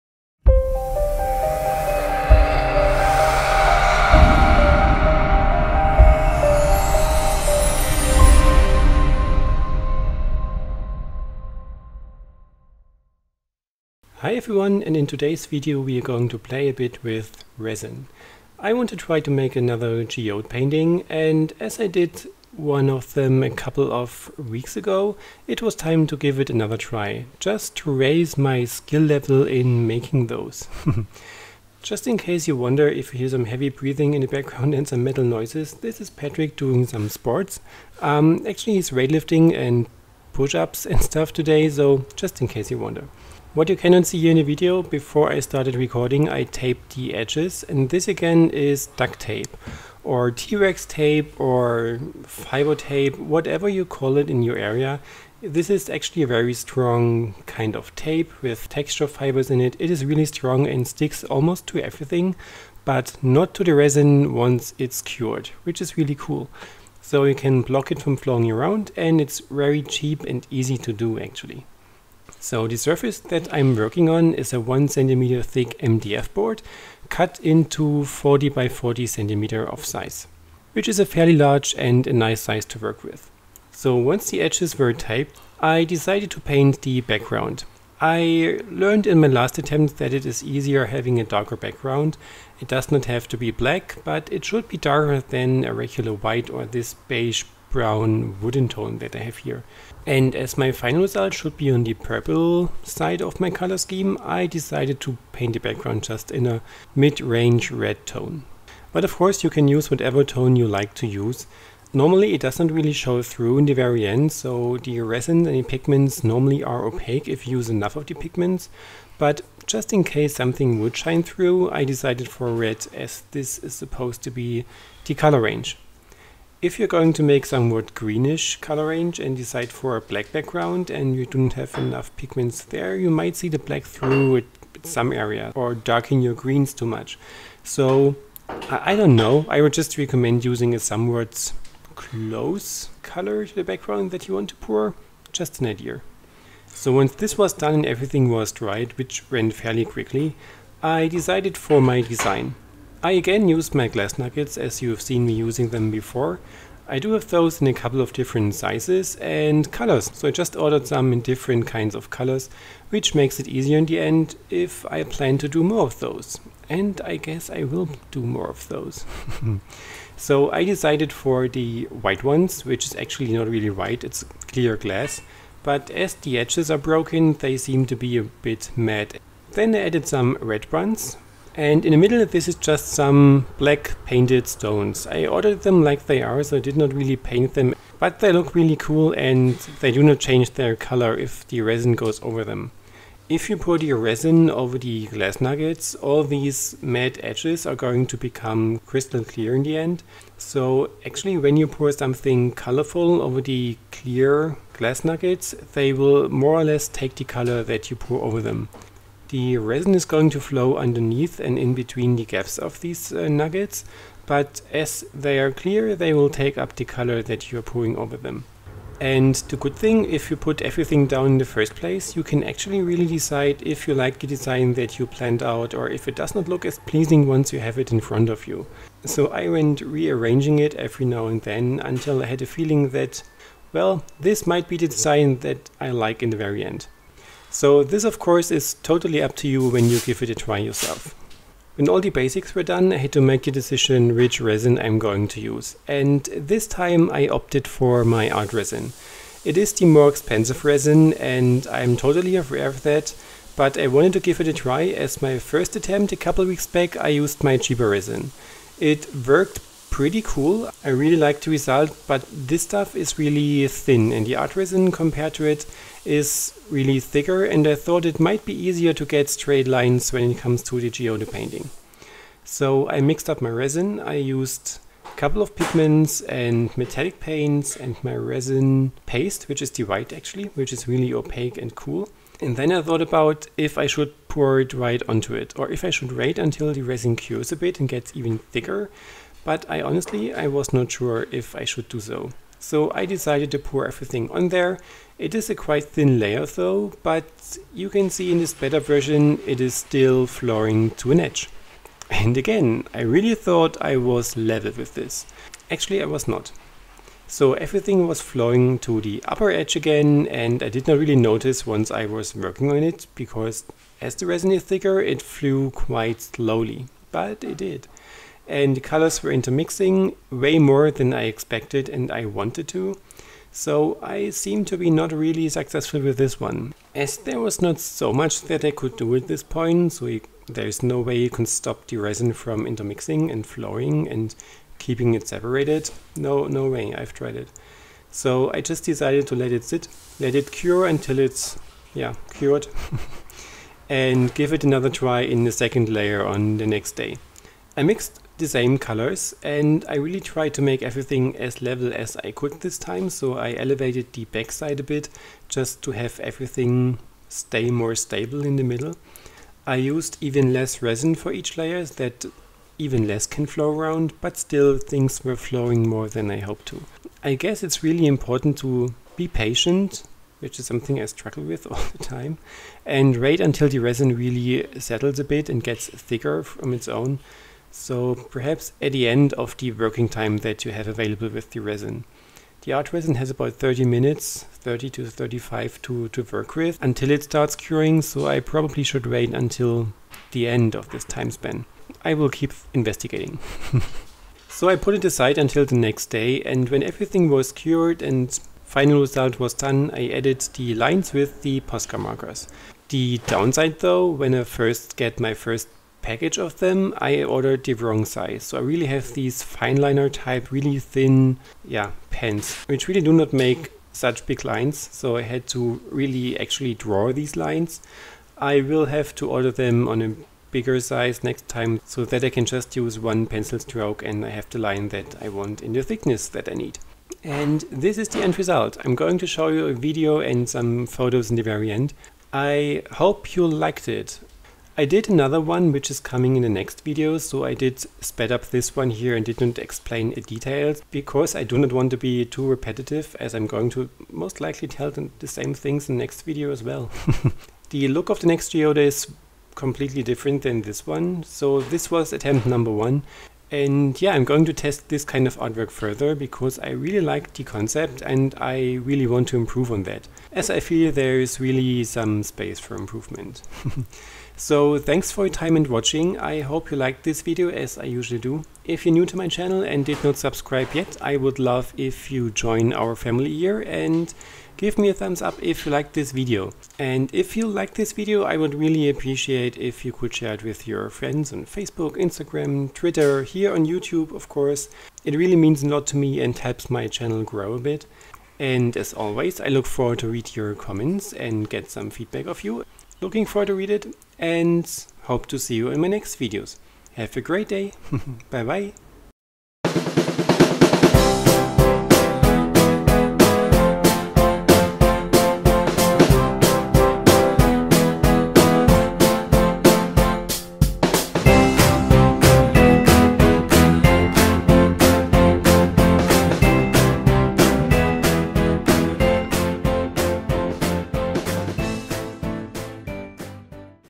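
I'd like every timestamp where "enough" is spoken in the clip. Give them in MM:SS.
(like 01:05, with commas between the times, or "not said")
01:57, 02:11.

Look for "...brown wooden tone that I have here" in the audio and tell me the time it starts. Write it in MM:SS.
01:37.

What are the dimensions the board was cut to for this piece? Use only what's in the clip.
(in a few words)
40 by 40 centimeters.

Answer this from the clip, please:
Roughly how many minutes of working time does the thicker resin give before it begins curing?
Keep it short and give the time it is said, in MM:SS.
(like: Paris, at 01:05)
30 to 35 minutes, at 06:24.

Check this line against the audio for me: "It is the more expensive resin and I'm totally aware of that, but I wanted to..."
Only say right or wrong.
right.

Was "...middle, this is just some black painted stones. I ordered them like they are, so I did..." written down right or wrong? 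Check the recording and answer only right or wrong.
right.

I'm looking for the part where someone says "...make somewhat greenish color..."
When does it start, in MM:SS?
02:07.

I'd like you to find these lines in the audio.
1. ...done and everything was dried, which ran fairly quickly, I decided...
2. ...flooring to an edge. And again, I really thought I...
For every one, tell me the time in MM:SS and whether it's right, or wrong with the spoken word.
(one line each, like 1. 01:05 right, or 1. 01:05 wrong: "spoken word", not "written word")
1. 02:27 right
2. 05:00 right.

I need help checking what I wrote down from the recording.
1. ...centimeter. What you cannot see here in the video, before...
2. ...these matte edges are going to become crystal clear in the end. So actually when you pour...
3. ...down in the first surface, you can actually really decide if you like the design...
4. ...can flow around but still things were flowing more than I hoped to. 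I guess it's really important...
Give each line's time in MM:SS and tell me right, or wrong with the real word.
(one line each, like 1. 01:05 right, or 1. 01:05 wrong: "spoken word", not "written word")
1. 00:42 wrong: "wonder", not "centimeter"
2. 03:16 right
3. 03:41 wrong: "place", not "surface"
4. 06:03 right.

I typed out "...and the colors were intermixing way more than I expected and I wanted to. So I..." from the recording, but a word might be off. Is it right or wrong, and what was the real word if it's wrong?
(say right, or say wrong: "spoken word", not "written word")
right.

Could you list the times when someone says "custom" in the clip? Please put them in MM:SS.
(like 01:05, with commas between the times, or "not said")
not said.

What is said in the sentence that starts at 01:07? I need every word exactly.
So you can block it from flowing around and it's very cheap and easy to do actually.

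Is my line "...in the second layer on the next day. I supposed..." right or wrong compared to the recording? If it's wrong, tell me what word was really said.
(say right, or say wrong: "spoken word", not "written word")
wrong: "mixed", not "supposed".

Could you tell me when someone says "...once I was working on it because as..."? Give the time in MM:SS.
05:11.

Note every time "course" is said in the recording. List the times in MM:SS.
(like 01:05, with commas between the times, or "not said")
01:49, 03:58, 08:04.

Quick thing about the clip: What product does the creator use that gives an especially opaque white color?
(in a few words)
Resin paste.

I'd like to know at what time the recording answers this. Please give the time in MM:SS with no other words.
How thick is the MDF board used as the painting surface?
01:14.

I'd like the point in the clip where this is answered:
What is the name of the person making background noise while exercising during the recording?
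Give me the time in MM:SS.
00:36.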